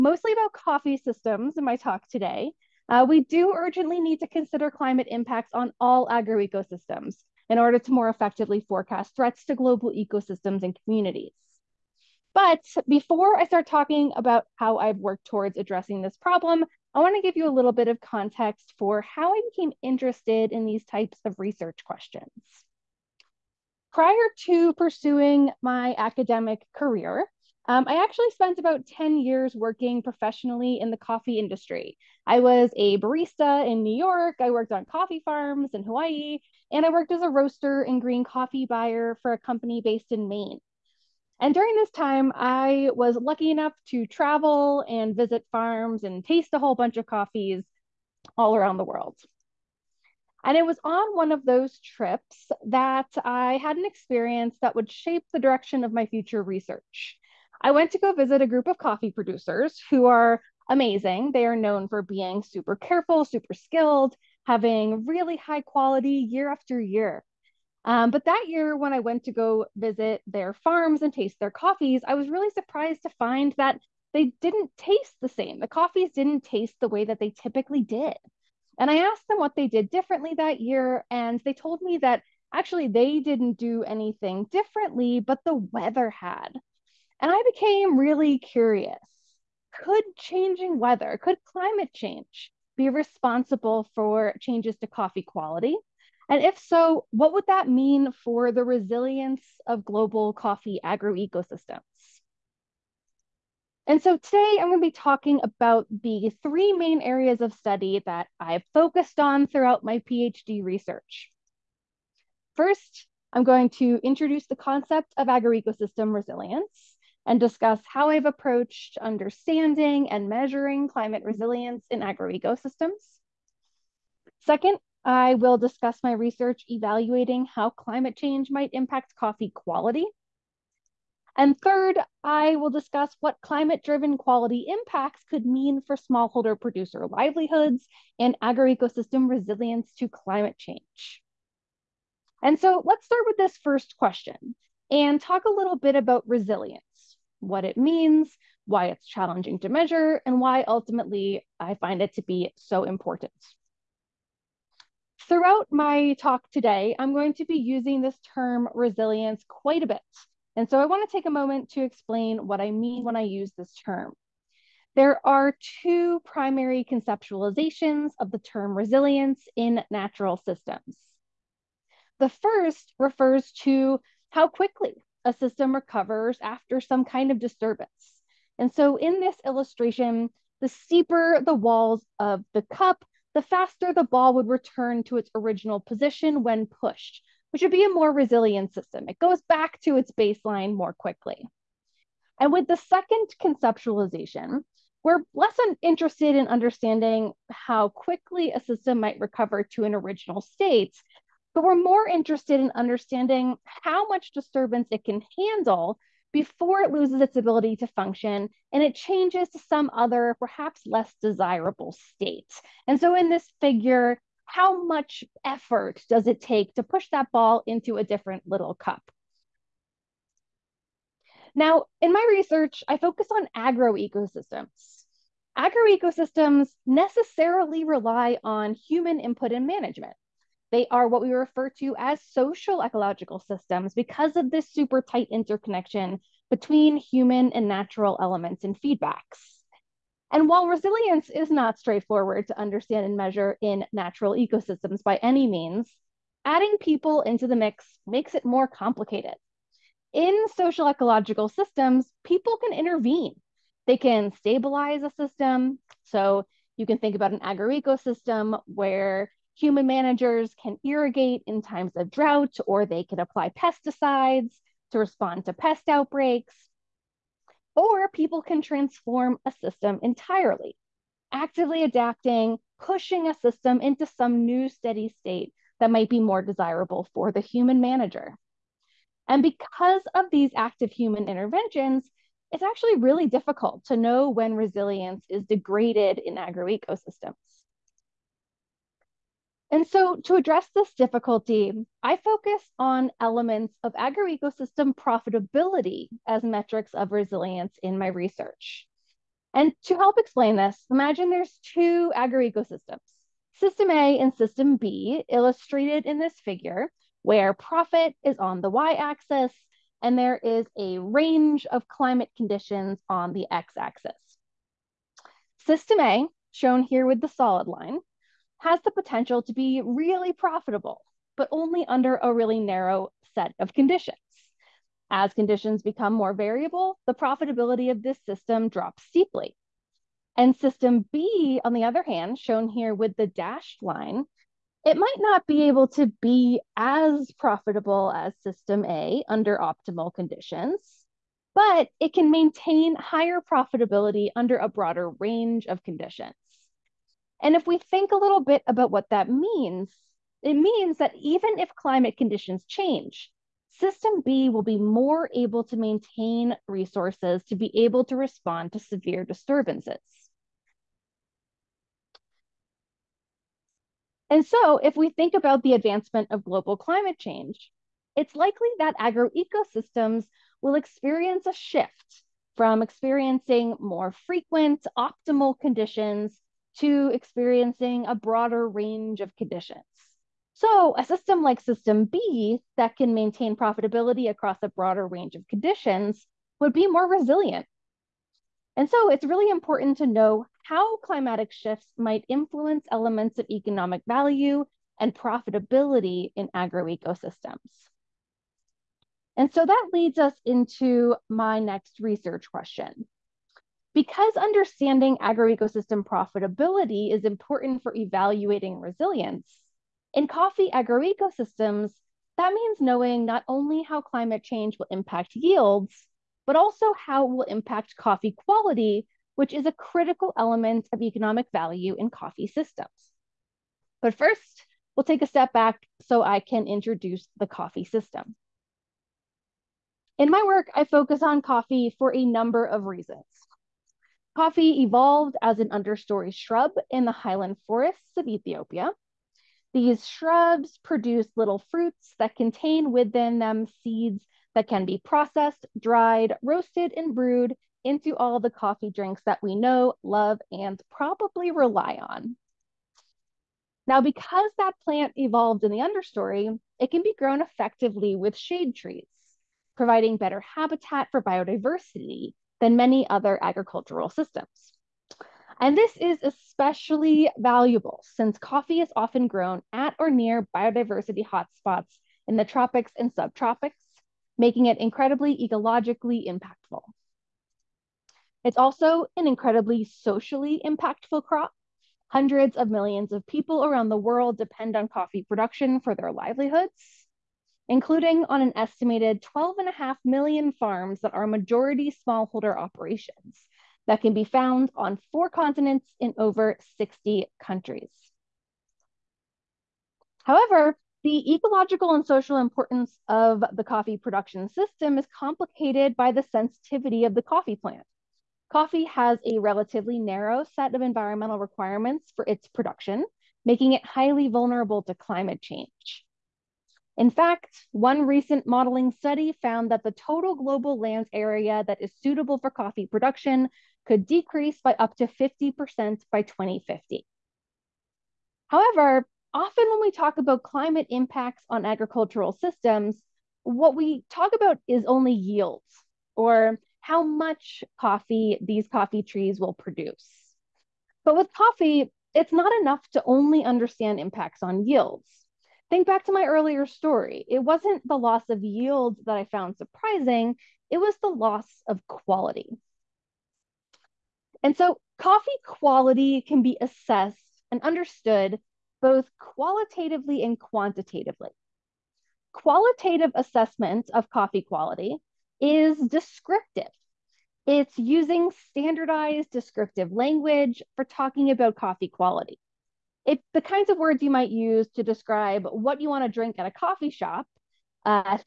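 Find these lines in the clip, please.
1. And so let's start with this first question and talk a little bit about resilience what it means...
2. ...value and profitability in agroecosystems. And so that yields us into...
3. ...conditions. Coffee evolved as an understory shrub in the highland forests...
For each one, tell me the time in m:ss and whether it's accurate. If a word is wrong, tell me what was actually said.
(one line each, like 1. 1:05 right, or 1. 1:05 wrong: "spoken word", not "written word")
1. 2:22 right
2. 6:34 wrong: "leads", not "yields"
3. 7:12 wrong: "reasons", not "conditions".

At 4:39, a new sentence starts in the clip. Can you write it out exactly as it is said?
And because of these active human interventions, it's actually really difficult to know when resilience is degraded in agroecosystems.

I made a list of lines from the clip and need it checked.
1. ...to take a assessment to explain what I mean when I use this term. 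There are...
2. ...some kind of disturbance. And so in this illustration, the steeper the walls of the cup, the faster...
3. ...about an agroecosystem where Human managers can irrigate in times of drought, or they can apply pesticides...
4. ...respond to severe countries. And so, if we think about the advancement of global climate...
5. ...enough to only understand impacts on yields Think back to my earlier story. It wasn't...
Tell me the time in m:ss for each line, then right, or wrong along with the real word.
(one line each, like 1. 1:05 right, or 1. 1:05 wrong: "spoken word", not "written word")
1. 2:41 wrong: "moment", not "assessment"
2. 2:56 right
3. 4:17 right
4. 5:58 wrong: "disturbances", not "countries"
5. 9:02 right.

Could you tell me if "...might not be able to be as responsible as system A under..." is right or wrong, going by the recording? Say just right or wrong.
wrong.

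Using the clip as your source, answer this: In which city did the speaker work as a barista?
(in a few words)
New York.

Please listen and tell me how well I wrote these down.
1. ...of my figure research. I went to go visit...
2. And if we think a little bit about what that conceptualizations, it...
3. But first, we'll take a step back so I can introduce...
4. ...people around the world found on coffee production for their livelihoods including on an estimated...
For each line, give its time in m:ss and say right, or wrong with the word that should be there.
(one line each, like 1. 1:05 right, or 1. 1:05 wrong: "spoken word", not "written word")
1. 0:55 wrong: "future", not "figure"
2. 5:47 wrong: "means", not "conceptualizations"
3. 7:04 right
4. 8:03 wrong: "depend", not "found".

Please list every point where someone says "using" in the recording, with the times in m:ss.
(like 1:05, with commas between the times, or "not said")
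2:37, 9:27.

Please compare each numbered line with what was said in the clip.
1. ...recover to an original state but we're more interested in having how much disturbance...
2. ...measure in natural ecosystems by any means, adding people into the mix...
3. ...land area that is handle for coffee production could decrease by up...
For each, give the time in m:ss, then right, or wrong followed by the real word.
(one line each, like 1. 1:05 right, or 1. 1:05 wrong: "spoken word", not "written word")
1. 3:19 wrong: "understanding", not "having"
2. 4:03 right
3. 8:40 wrong: "suitable", not "handle".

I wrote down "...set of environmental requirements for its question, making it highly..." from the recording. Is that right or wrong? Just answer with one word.
wrong.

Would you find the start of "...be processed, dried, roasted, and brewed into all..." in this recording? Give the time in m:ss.
7:24.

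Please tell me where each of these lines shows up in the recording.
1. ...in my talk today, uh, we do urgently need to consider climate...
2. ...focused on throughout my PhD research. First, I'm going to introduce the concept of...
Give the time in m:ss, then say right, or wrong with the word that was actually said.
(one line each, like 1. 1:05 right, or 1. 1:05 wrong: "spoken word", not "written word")
1. 0:01 right
2. 1:48 right.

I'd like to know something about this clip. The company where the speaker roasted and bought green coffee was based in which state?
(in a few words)
Maine.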